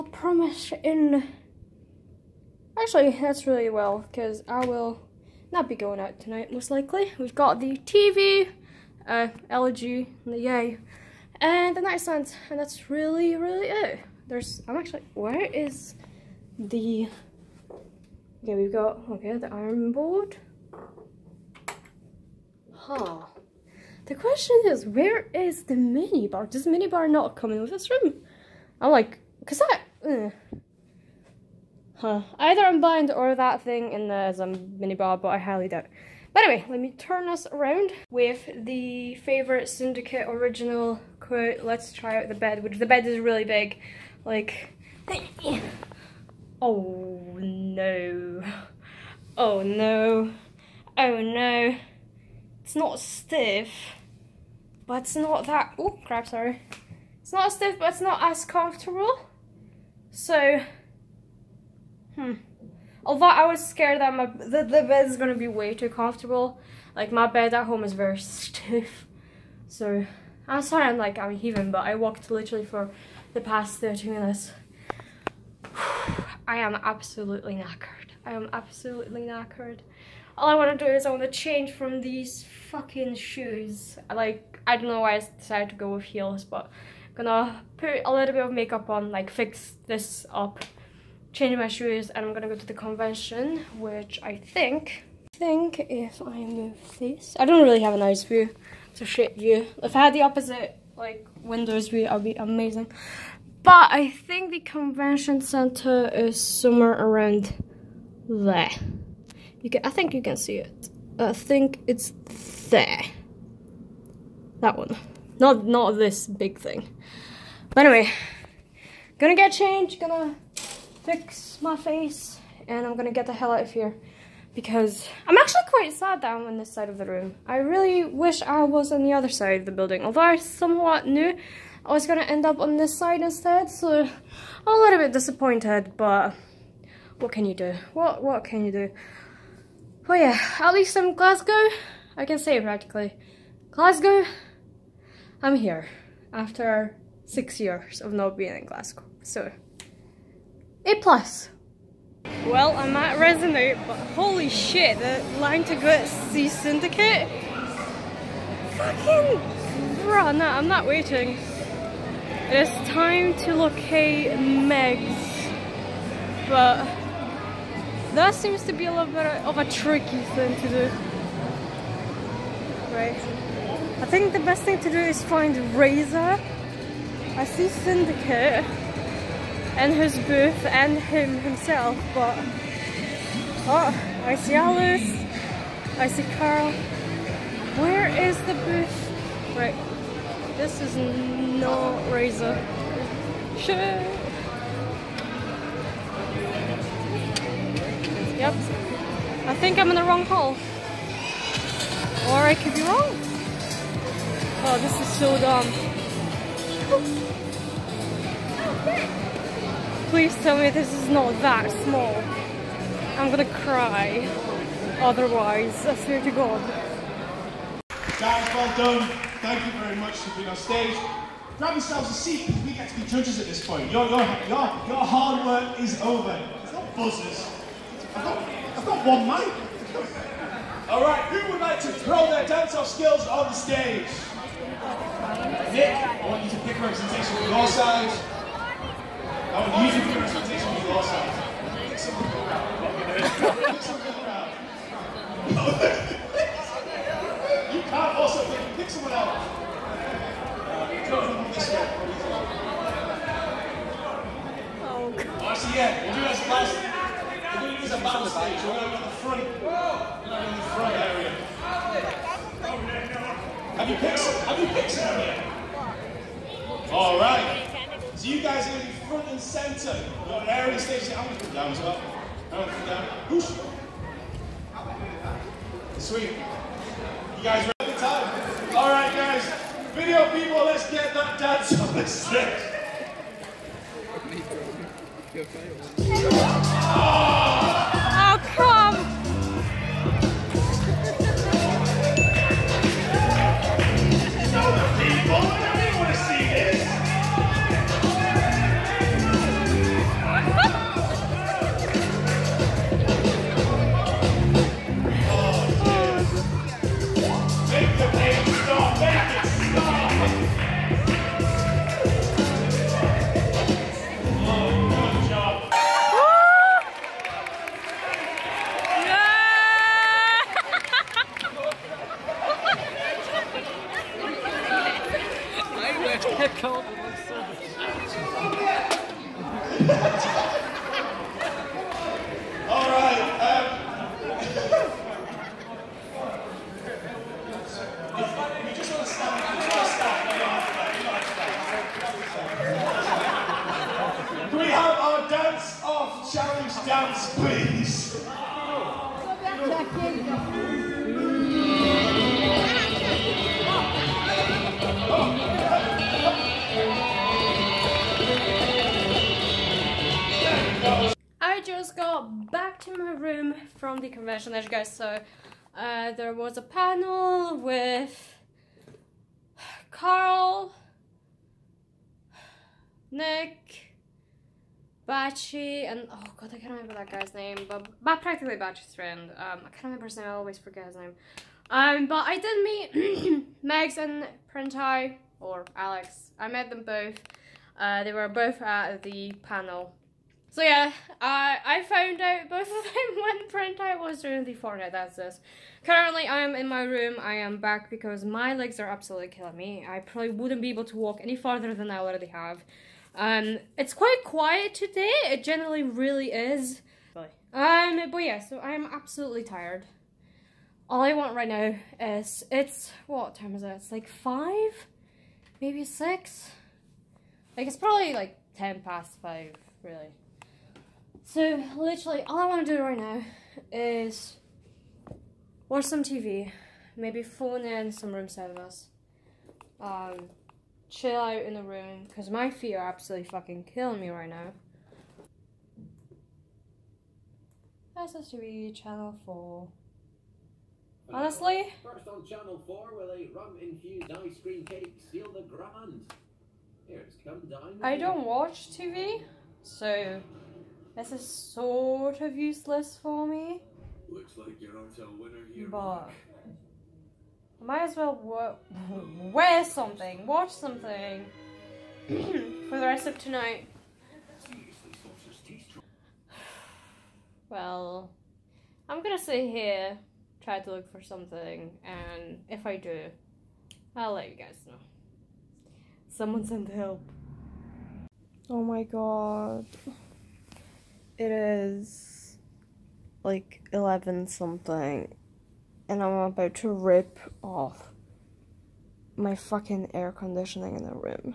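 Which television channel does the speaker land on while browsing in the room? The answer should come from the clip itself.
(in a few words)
Channel 4.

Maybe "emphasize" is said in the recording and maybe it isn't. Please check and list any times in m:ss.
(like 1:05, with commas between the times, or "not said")
not said.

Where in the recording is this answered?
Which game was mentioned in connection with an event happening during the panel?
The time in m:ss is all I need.
6:34.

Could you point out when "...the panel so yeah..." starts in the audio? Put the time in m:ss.
6:29.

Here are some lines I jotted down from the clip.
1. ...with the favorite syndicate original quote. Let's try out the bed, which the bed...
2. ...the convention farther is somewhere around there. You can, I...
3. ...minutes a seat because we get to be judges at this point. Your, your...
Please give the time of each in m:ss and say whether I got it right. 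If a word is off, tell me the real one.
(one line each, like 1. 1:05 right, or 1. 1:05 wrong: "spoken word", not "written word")
1. 0:38 right
2. 1:44 wrong: "center", not "farther"
3. 3:41 wrong: "yourselves", not "minutes".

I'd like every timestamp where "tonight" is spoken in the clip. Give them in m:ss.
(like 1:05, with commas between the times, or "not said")
0:06, 7:43.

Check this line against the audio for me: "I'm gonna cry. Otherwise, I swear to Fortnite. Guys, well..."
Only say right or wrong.
wrong.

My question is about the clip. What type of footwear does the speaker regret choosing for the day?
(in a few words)
Heels.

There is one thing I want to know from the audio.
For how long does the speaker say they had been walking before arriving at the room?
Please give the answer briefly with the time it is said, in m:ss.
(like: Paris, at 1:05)
30 minutes, at 1:13.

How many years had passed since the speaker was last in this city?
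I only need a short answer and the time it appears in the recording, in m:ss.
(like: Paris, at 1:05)
6, at 2:27.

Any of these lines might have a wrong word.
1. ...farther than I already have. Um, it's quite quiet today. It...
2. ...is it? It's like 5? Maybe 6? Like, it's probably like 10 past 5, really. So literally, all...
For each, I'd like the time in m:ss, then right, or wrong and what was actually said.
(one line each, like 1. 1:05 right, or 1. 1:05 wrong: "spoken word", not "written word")
1. 6:41 right
2. 6:53 right.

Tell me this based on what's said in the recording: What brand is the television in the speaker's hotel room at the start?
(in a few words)
LG.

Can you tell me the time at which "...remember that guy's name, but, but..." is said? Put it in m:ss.
6:16.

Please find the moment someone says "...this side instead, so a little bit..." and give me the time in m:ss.
2:12.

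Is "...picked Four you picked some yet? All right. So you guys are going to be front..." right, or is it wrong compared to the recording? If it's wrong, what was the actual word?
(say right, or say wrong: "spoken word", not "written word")
wrong: "Have", not "Four".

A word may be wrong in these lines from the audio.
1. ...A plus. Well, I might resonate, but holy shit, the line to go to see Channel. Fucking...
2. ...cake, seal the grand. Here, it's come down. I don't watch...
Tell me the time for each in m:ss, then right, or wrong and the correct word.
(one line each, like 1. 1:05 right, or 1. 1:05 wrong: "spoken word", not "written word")
1. 2:30 wrong: "Syndicate", not "Channel"
2. 7:24 right.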